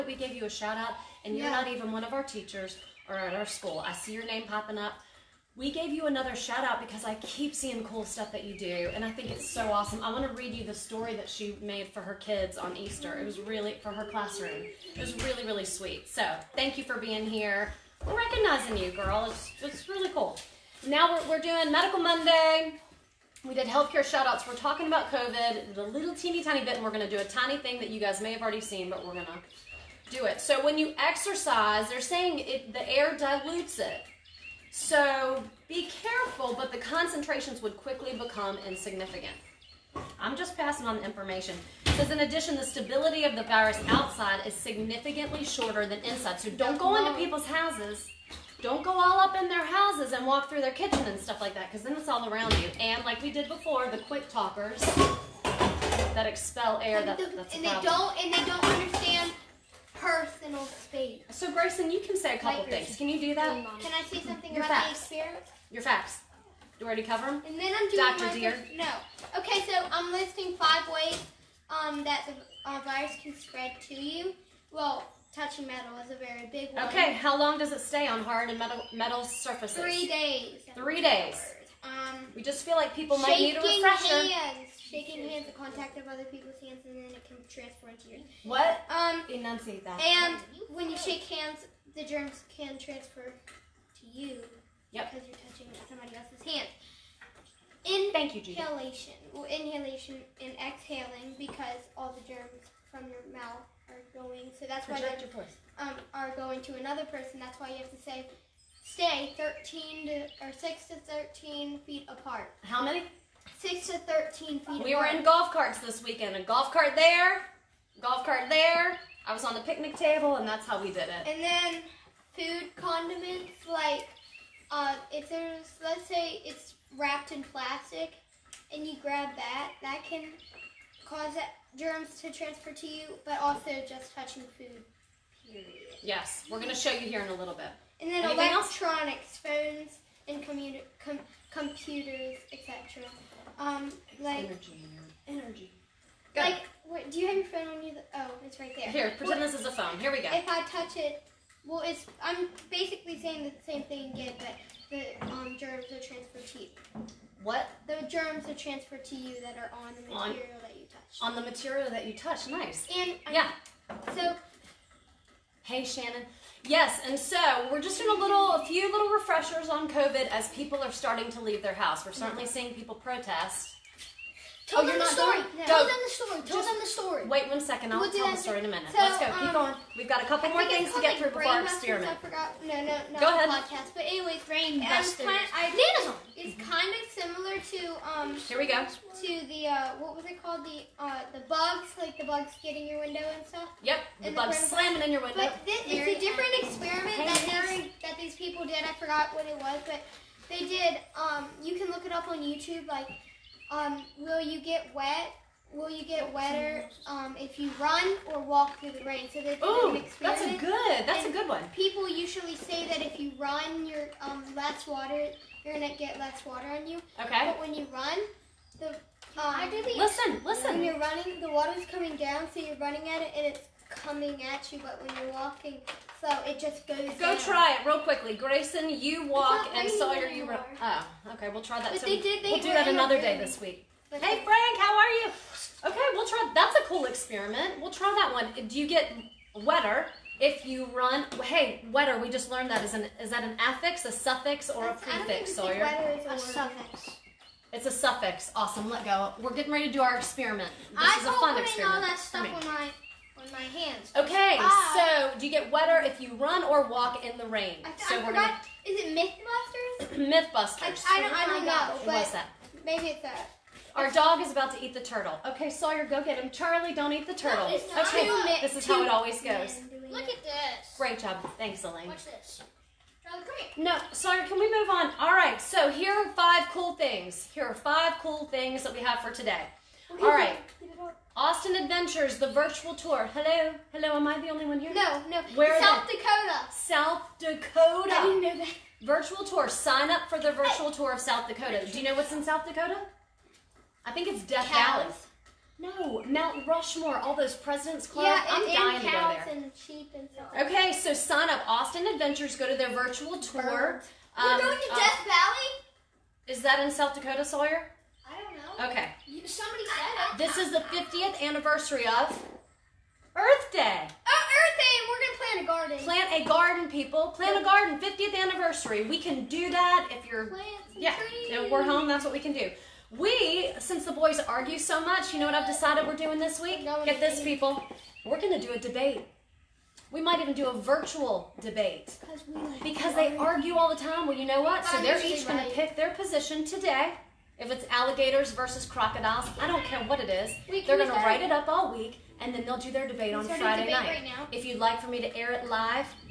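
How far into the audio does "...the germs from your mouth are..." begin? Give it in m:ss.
1:42.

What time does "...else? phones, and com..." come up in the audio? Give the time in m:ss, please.
2:19.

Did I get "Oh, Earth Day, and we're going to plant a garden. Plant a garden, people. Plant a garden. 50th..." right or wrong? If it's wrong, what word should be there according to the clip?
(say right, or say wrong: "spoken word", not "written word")
right.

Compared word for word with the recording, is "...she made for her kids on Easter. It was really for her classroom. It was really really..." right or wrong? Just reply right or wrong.
right.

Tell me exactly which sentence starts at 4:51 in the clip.
Do you know what's in South Dakota?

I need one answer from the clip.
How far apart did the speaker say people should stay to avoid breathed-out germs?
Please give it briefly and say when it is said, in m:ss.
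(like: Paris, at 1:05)
6 to 13 feet, at 1:50.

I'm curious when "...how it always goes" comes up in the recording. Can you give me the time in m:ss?
4:28.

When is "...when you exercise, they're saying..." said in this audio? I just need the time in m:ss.
0:30.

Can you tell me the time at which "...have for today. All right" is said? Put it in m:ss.
4:38.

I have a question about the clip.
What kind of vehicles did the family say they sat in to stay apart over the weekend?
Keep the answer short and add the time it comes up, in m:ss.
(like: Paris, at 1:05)
Golf carts, at 1:55.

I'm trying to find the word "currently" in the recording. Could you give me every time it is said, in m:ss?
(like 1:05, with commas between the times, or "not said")
not said.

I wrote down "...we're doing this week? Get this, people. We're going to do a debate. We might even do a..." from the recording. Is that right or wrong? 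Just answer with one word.
right.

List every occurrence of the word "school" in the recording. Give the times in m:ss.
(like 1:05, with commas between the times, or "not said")
0:03.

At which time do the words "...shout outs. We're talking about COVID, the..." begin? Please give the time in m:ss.
0:24.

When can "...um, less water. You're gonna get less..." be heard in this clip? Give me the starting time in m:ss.
3:34.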